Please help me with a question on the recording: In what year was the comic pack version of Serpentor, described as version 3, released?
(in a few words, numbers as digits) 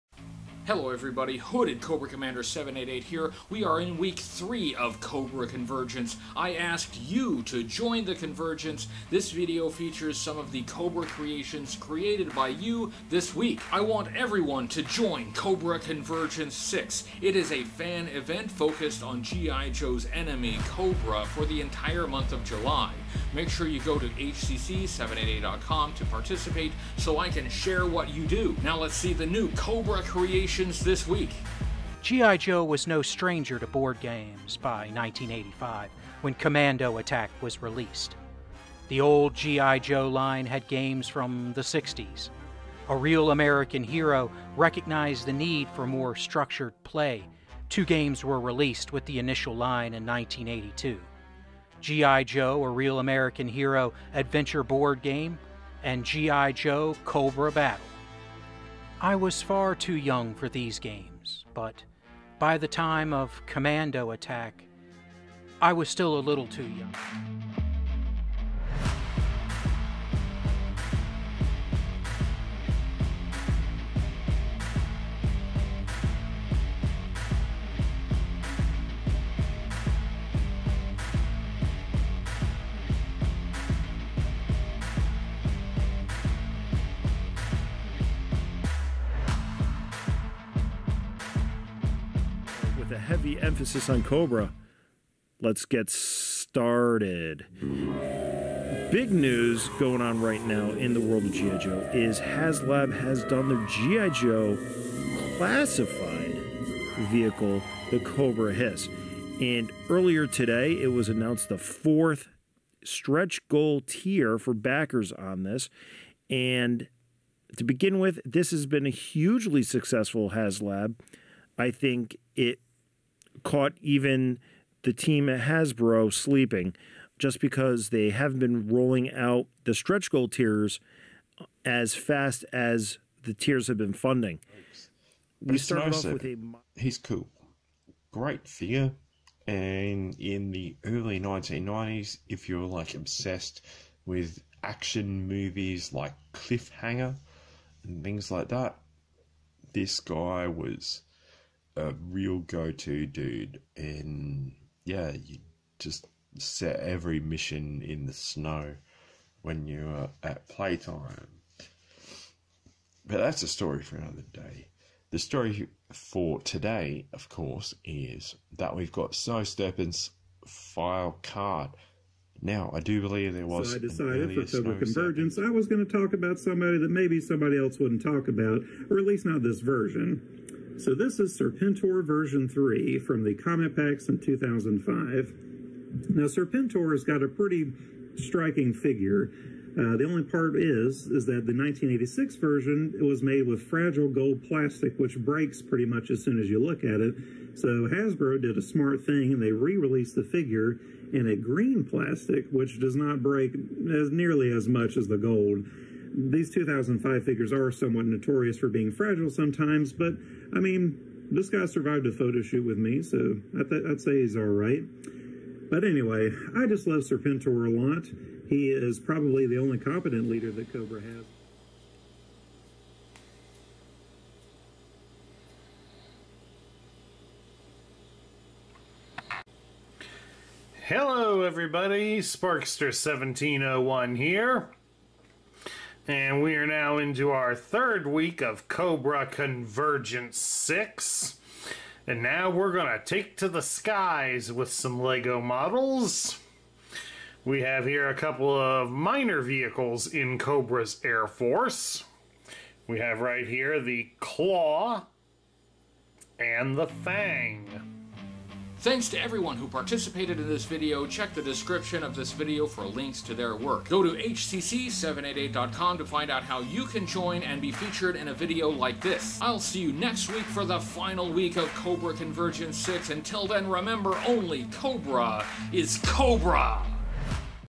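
2005.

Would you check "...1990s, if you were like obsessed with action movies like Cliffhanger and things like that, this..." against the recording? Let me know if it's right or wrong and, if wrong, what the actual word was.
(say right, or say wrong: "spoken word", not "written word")
right.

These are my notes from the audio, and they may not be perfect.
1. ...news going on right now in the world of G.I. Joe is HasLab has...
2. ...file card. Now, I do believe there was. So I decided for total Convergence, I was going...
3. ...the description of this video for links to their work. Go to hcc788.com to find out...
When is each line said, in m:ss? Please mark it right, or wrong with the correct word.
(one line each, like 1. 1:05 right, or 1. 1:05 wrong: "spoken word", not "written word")
1. 1:39 right
2. 2:50 right
3. 4:21 right.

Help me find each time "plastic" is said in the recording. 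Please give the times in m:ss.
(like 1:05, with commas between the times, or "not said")
3:14, 3:21.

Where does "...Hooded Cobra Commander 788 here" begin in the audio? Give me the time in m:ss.
0:01.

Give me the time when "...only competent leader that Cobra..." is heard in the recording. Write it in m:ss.
3:39.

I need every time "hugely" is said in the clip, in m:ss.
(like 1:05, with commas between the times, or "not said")
1:58.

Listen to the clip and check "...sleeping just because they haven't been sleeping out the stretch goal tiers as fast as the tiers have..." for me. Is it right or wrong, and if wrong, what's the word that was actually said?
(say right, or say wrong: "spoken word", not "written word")
wrong: "rolling", not "sleeping".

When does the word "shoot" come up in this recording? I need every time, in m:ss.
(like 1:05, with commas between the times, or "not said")
3:32.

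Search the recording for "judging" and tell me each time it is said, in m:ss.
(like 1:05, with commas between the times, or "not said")
not said.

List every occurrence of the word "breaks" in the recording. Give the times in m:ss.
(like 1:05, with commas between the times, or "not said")
3:15, 3:23.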